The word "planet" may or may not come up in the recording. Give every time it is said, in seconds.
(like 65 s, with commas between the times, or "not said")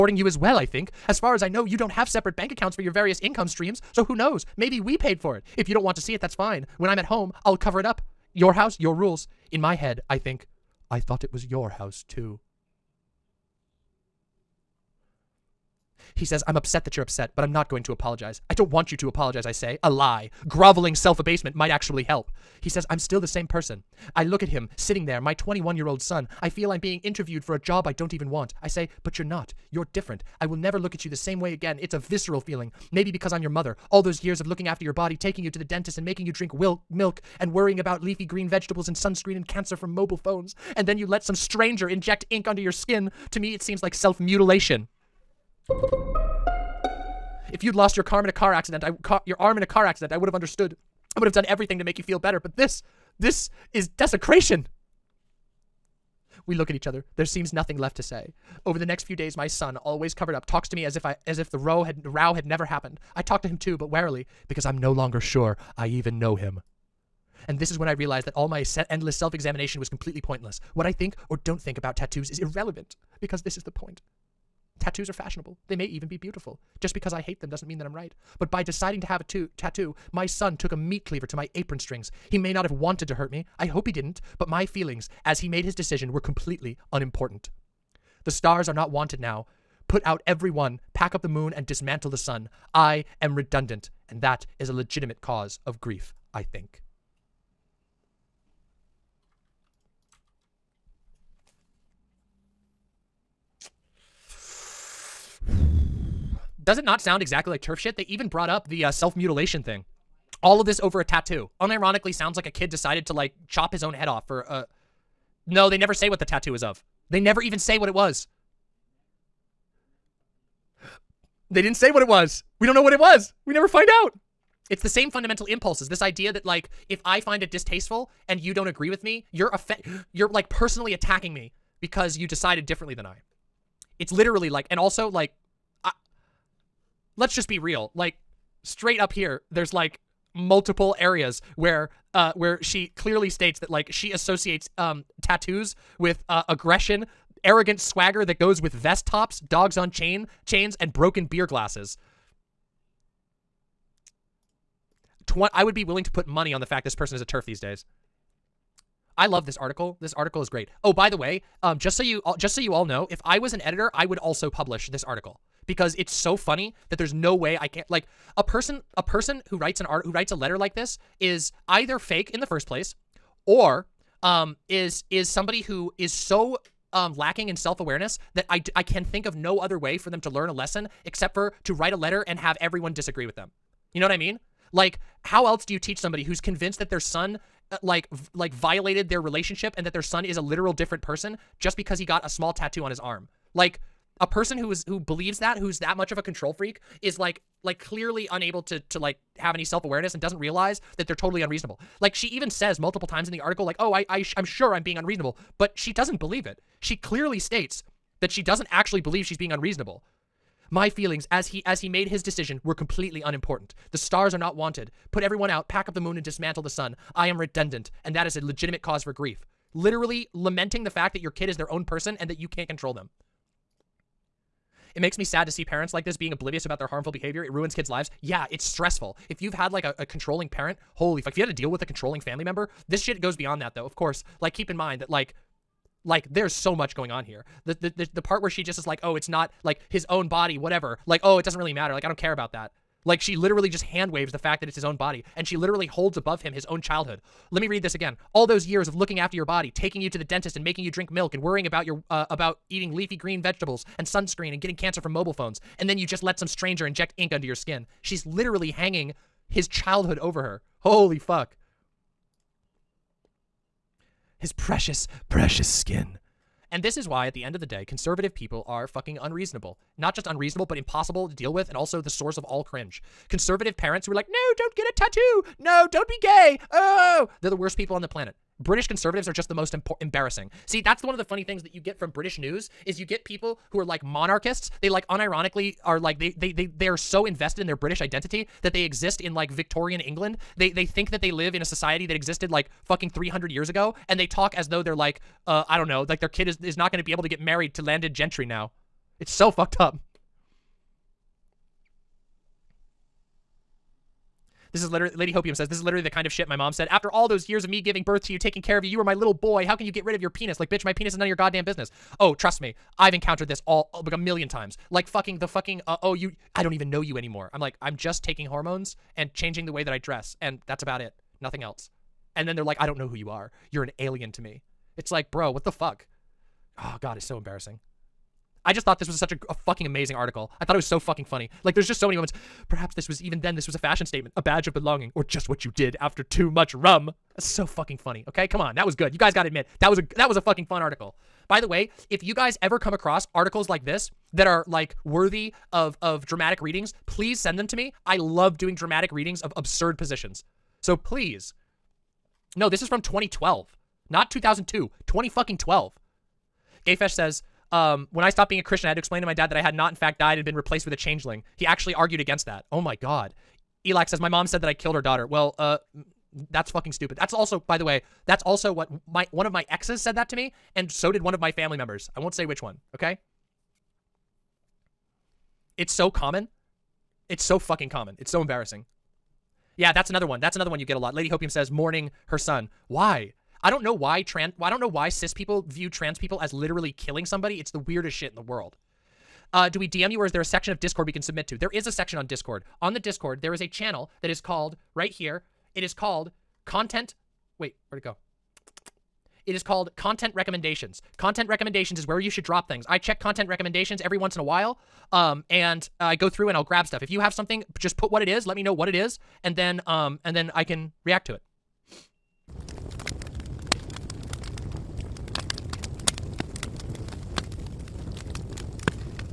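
278 s.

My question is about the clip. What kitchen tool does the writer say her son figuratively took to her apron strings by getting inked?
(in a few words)
meat cleaver.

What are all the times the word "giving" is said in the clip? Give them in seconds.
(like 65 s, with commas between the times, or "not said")
307 s.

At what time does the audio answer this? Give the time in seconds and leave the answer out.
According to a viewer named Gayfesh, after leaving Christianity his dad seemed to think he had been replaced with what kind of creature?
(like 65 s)
360 s.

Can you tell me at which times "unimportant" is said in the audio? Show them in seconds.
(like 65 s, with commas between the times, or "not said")
86 s, 213 s.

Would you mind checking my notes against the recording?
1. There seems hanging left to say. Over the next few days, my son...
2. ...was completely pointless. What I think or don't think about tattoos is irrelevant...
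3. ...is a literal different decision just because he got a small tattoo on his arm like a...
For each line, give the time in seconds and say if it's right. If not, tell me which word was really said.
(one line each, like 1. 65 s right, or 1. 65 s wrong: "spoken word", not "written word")
1. 57 s wrong: "nothing", not "hanging"
2. 69 s right
3. 190 s wrong: "person", not "decision".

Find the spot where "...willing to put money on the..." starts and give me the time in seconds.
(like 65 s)
155 s.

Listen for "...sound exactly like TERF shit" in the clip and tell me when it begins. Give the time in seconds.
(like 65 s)
106 s.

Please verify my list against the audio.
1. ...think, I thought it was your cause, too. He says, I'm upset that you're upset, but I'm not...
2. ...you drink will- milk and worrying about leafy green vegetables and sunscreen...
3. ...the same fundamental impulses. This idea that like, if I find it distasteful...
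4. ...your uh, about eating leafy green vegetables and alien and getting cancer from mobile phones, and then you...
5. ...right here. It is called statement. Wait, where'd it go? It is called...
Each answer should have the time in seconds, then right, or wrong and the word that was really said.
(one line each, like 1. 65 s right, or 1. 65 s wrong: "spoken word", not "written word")
1. 10 s wrong: "house", not "cause"
2. 36 s right
3. 124 s right
4. 251 s wrong: "sunscreen", not "alien"
5. 394 s wrong: "content", not "statement".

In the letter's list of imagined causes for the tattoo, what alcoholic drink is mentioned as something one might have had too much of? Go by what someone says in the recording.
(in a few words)
rum.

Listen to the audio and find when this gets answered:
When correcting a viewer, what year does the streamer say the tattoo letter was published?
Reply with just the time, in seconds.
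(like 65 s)
355 s.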